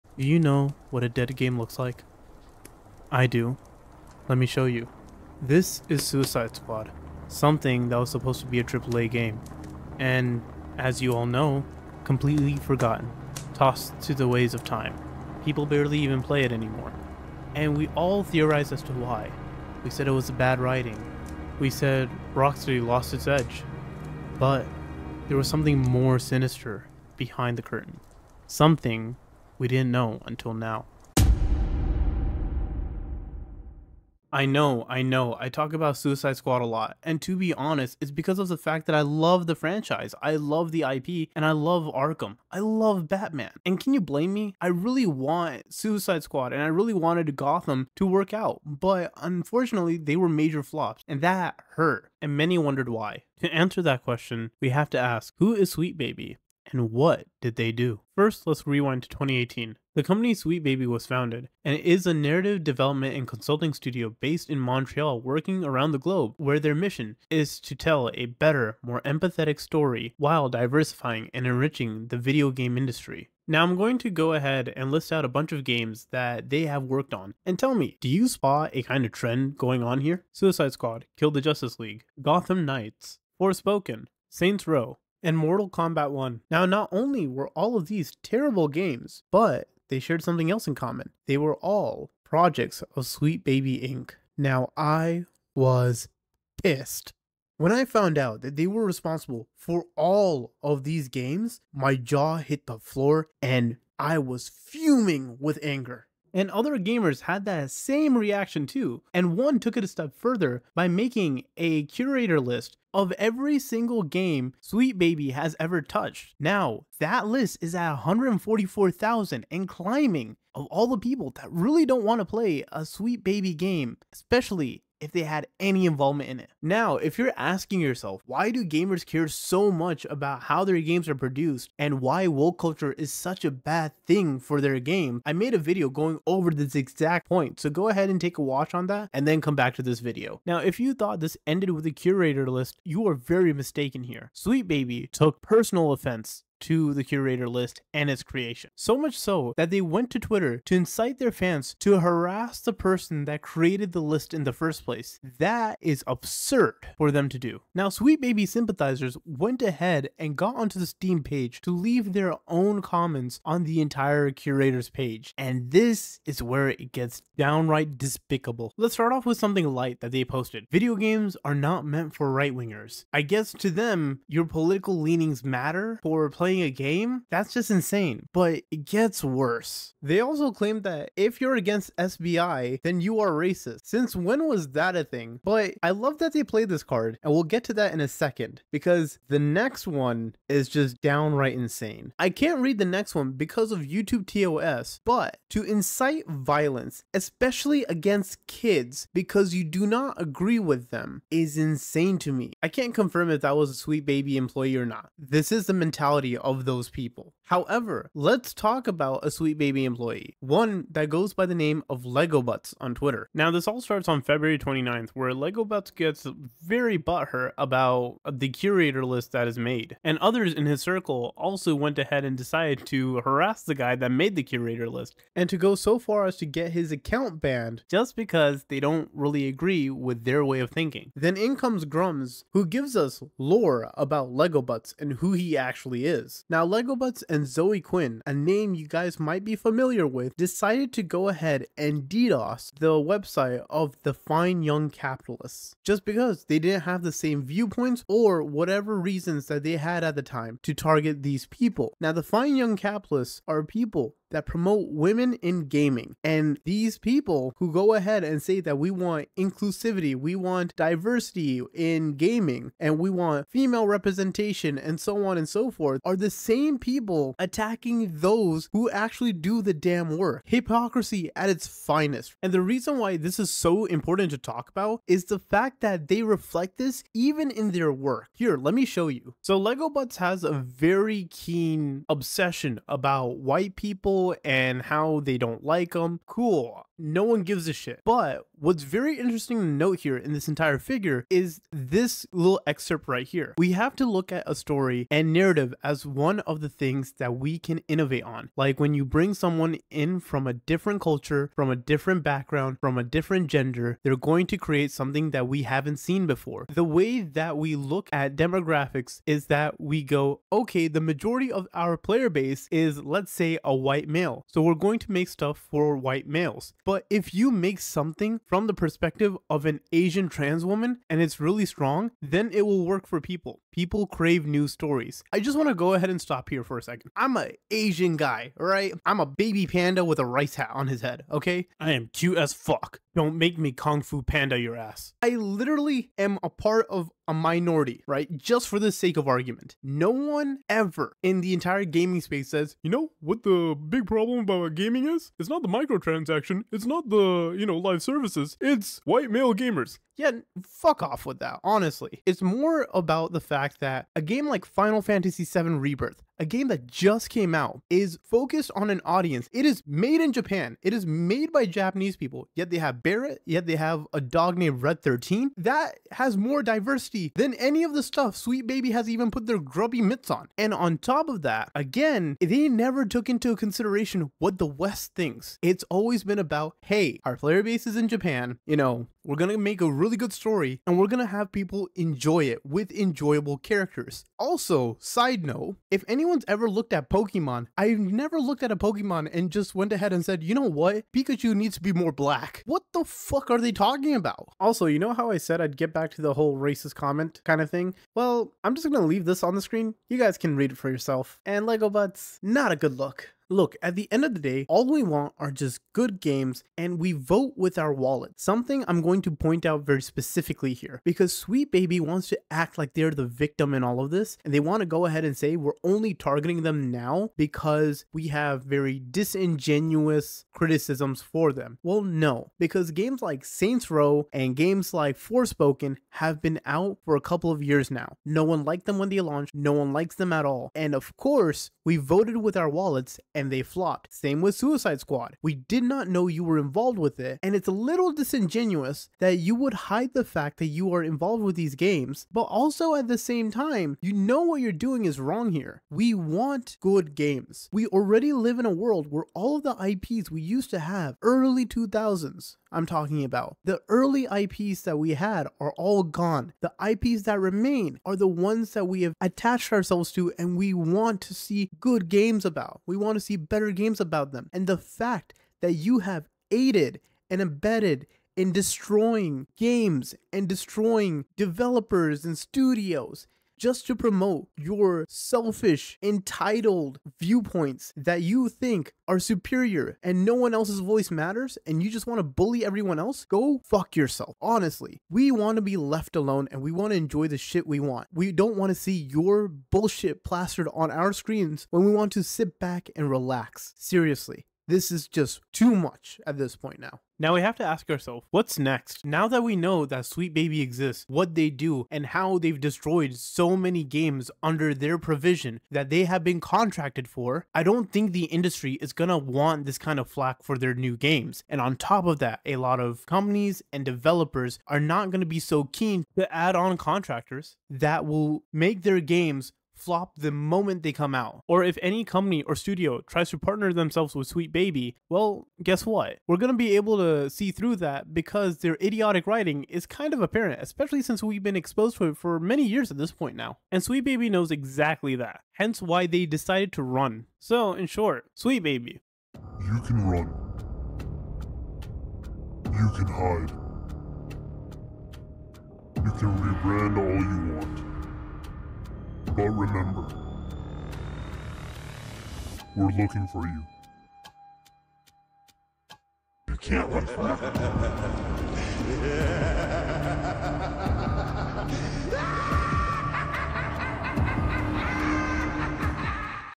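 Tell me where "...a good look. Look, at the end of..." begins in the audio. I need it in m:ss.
6:42.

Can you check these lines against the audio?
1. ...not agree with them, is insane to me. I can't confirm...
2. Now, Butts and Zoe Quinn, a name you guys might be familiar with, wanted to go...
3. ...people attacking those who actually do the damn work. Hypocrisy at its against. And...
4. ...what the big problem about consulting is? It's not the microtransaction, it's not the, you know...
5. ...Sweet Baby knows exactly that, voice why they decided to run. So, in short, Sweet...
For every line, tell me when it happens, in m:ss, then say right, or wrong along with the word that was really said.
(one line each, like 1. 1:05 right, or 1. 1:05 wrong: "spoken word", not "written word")
1. 3:19 right
2. 3:56 wrong: "decided", not "wanted"
3. 4:26 wrong: "finest", not "against"
4. 5:43 wrong: "gaming", not "consulting"
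5. 8:53 wrong: "hence", not "voice".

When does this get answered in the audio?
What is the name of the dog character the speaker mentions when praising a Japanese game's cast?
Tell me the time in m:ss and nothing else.
6:04.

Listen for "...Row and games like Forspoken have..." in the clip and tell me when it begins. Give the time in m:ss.
7:03.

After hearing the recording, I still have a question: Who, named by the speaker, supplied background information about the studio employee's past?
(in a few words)
Grummz.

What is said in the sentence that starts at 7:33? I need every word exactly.
The early IPs that we had are all gone.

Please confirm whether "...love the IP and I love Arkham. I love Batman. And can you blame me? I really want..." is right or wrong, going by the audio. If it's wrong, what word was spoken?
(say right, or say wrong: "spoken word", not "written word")
right.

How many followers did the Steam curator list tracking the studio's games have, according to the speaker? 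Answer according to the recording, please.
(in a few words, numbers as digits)
144,000.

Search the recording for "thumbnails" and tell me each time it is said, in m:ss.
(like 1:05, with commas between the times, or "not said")
not said.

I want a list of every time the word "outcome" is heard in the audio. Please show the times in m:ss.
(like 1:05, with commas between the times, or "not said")
not said.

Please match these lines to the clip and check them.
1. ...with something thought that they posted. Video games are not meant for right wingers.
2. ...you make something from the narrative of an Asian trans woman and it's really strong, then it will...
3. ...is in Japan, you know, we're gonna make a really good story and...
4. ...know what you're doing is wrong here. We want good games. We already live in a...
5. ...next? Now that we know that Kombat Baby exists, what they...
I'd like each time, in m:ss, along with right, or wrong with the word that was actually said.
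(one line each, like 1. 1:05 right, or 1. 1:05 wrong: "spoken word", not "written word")
1. 2:49 wrong: "light", not "thought"
2. 5:17 wrong: "perspective", not "narrative"
3. 6:17 right
4. 7:24 right
5. 8:18 wrong: "Sweet", not "Kombat".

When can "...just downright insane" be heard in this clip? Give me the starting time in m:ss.
3:10.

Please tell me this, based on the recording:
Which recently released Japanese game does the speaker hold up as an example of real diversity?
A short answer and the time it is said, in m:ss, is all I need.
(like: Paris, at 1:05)
Final Fantasy VII Rebirth, at 5:54.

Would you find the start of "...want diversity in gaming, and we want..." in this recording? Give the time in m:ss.
4:20.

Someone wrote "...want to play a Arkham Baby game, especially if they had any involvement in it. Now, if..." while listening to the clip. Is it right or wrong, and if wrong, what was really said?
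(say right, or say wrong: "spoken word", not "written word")
wrong: "Sweet", not "Arkham".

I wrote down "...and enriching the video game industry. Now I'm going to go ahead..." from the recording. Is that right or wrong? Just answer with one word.
right.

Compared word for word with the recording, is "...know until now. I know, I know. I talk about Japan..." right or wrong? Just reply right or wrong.
wrong.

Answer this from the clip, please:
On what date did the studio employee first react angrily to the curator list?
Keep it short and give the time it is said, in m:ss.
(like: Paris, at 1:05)
February 29th, at 3:34.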